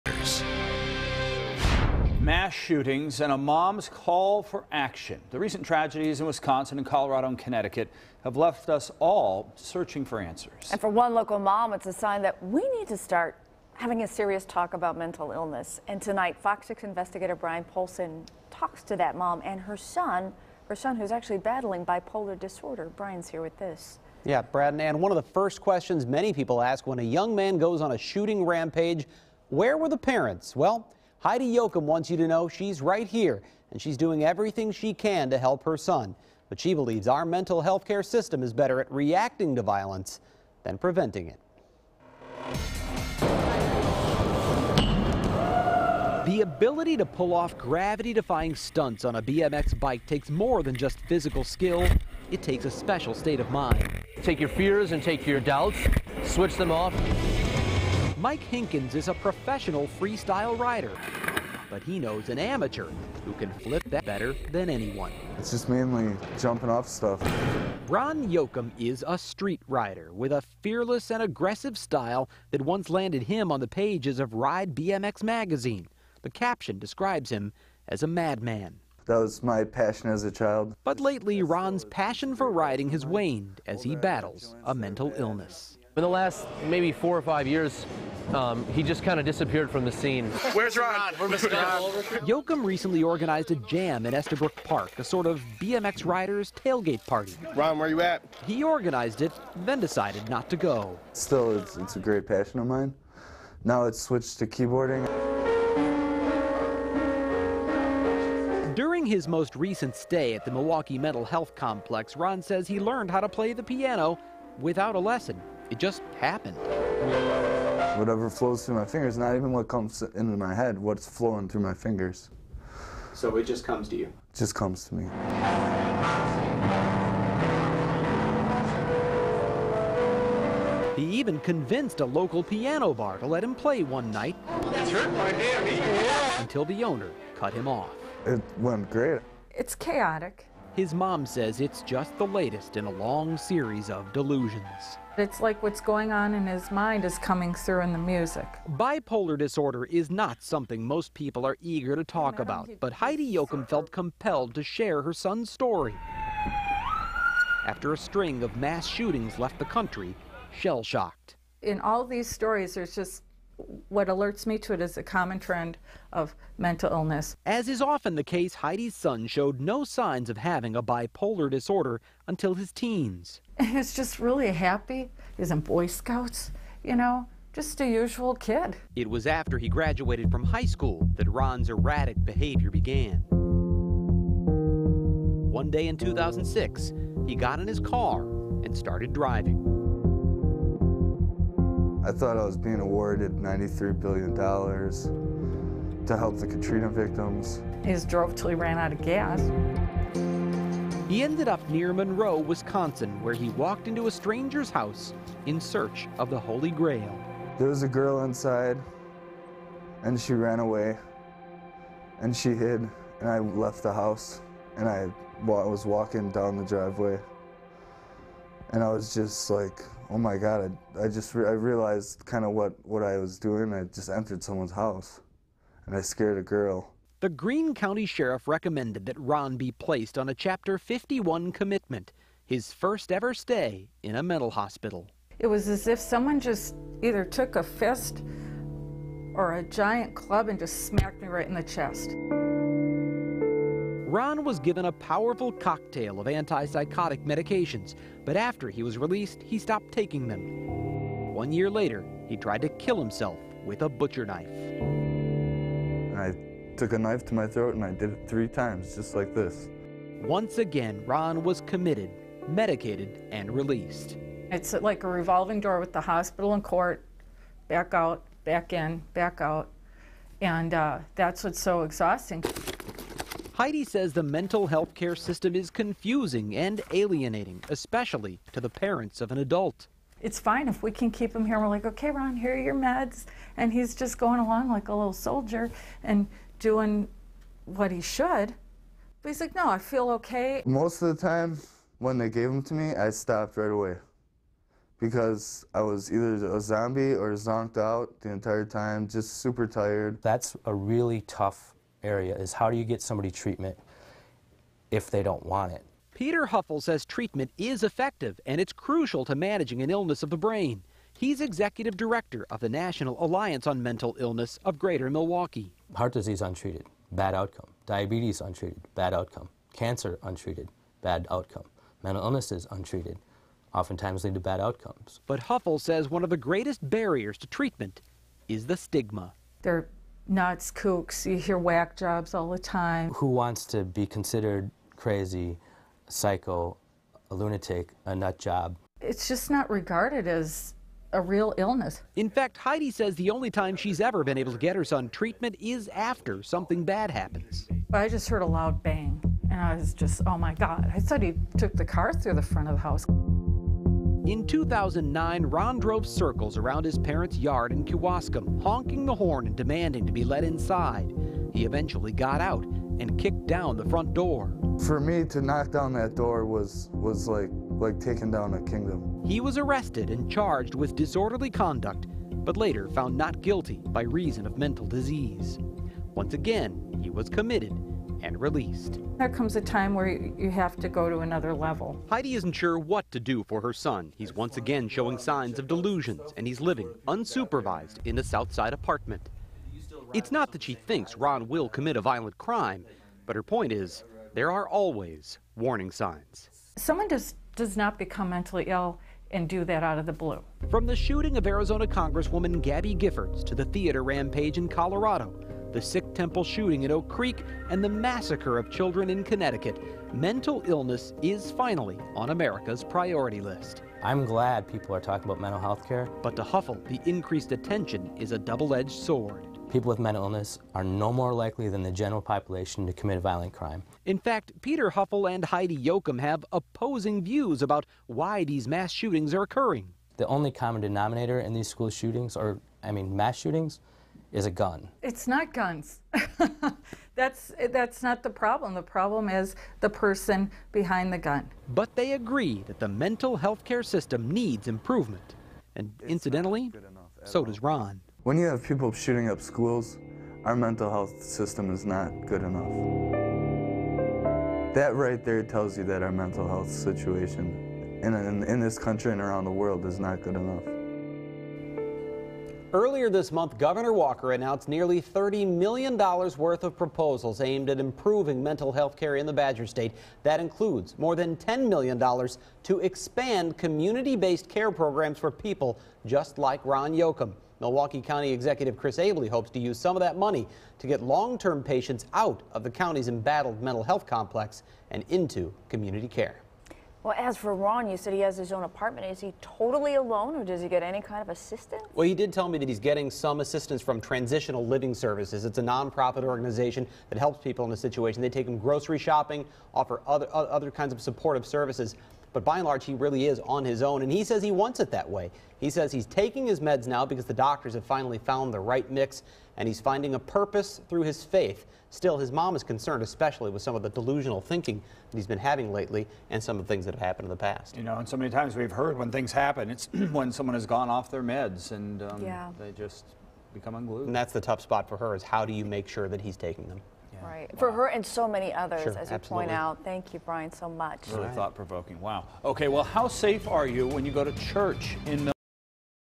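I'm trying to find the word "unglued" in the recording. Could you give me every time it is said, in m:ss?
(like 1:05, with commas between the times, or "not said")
8:43.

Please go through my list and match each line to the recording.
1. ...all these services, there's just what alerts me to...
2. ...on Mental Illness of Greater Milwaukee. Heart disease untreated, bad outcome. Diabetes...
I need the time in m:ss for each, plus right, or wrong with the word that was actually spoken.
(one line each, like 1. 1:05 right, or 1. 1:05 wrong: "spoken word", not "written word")
1. 2:41 wrong: "stories", not "services"
2. 5:13 right.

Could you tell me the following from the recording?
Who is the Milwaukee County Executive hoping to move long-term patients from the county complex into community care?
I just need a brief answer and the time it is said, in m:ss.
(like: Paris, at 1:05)
Chris Abele, at 7:58.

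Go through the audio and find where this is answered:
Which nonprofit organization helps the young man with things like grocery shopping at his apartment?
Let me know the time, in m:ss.
8:13.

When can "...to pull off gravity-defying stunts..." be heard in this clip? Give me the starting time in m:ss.
0:46.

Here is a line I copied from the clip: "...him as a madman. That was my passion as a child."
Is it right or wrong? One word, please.
right.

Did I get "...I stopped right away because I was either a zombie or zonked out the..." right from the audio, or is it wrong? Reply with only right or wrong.
right.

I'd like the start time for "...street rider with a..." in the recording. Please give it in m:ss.
1:09.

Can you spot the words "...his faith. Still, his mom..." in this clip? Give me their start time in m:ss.
8:31.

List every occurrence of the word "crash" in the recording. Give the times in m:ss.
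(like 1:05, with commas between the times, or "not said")
not said.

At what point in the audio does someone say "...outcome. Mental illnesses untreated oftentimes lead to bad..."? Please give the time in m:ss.
5:21.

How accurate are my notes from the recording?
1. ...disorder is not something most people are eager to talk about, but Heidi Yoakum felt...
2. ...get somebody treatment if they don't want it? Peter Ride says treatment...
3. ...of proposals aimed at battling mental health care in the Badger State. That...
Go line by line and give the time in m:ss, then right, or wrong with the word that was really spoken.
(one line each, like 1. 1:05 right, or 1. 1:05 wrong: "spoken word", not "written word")
1. 2:29 right
2. 5:02 wrong: "Hoeffel", not "Ride"
3. 7:46 wrong: "improving", not "battling".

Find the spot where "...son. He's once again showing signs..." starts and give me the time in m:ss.
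6:23.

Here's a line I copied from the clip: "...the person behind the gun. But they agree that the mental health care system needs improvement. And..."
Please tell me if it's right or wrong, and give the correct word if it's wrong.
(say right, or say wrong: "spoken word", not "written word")
right.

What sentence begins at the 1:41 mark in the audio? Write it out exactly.
Still, it's, it's a great passion of mine.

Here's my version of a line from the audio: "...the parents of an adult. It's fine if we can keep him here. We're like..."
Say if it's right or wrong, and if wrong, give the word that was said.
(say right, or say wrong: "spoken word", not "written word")
right.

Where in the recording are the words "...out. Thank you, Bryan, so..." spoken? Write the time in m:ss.
8:49.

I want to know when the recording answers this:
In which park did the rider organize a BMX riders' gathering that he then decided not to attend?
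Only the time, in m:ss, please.
1:34.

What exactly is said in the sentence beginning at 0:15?
And tonight, Fox 6 investigator Bryan Polcyn talks to that mom and her son, her son who's actually battling bipolar disorder.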